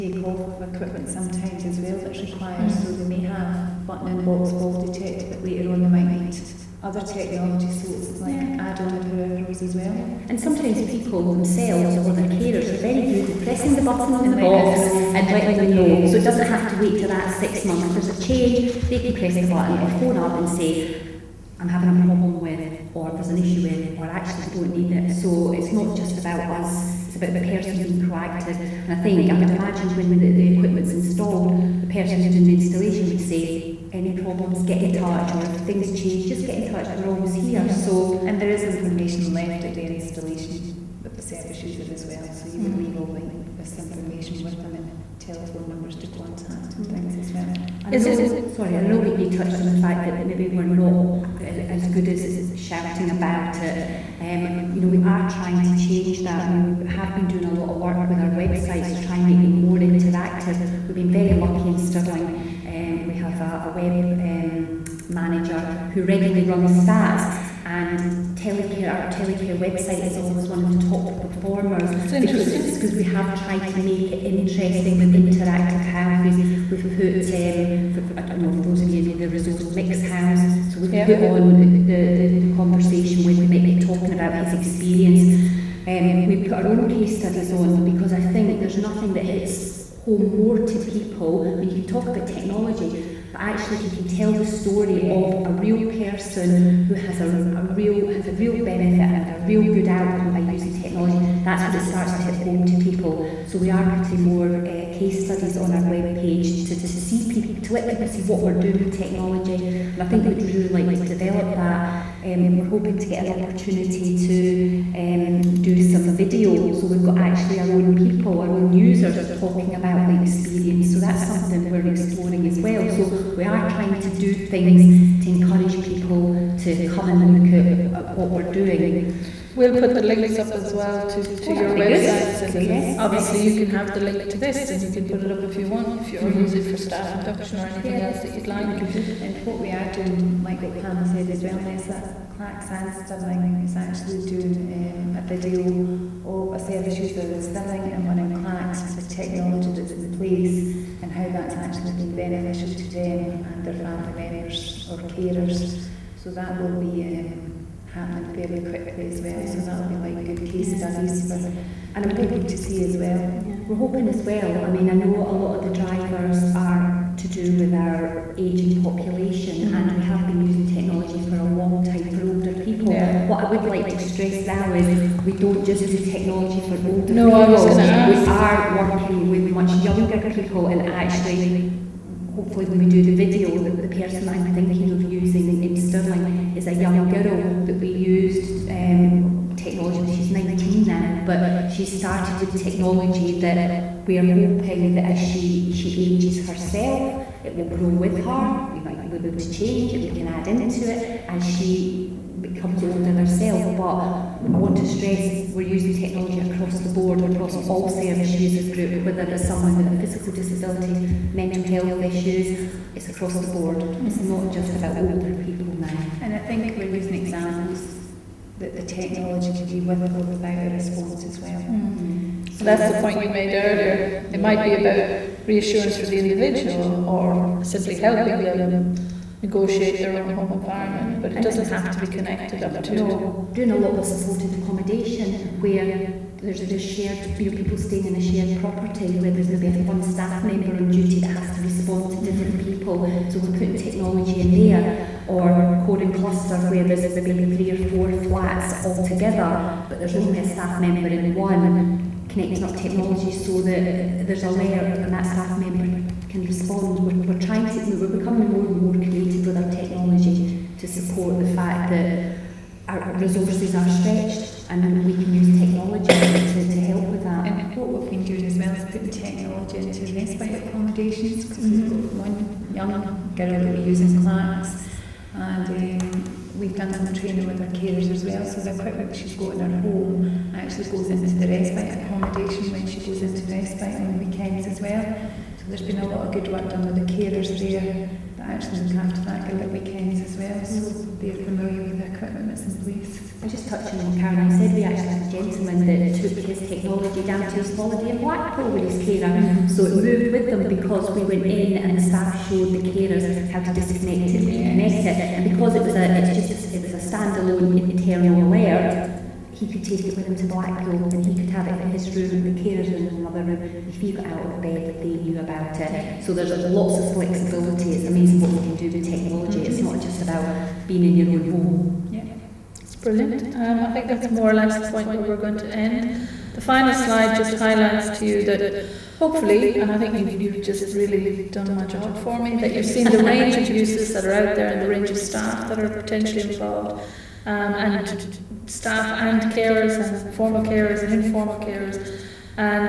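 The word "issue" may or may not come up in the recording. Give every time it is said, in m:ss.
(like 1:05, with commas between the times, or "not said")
0:23, 3:32.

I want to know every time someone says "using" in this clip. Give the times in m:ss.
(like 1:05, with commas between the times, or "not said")
1:40, 2:50, 3:05, 3:25, 3:36.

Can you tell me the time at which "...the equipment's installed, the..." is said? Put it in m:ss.
0:30.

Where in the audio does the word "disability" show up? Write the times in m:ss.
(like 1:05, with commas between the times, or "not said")
3:30.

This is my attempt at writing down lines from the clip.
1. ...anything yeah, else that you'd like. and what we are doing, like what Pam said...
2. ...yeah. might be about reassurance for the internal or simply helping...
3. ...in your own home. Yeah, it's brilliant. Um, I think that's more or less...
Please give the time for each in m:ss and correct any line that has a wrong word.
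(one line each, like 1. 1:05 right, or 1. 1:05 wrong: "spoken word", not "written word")
1. 2:17 right
2. 3:44 wrong: "individual", not "internal"
3. 5:21 right.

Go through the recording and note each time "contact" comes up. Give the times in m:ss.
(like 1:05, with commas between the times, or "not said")
0:46.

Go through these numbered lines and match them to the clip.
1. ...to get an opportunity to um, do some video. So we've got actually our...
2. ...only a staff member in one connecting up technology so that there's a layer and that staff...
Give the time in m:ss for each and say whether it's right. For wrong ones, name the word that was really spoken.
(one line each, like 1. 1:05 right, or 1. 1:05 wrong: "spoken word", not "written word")
1. 1:52 right
2. 4:10 right.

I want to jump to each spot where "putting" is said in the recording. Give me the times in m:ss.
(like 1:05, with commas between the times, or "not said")
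1:43, 4:03, 4:28.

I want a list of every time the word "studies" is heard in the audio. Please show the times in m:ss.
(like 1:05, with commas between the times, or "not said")
1:27, 1:45, 2:40.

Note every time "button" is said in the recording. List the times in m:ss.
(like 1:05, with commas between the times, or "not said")
0:03, 0:13, 0:19.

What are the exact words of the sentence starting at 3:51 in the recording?
but it and doesn't have to be connected up to.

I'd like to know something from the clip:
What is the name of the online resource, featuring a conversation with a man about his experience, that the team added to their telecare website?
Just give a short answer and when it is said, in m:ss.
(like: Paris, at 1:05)
Mick's house, at 1:19.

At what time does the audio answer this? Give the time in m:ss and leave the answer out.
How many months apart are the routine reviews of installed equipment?
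0:17.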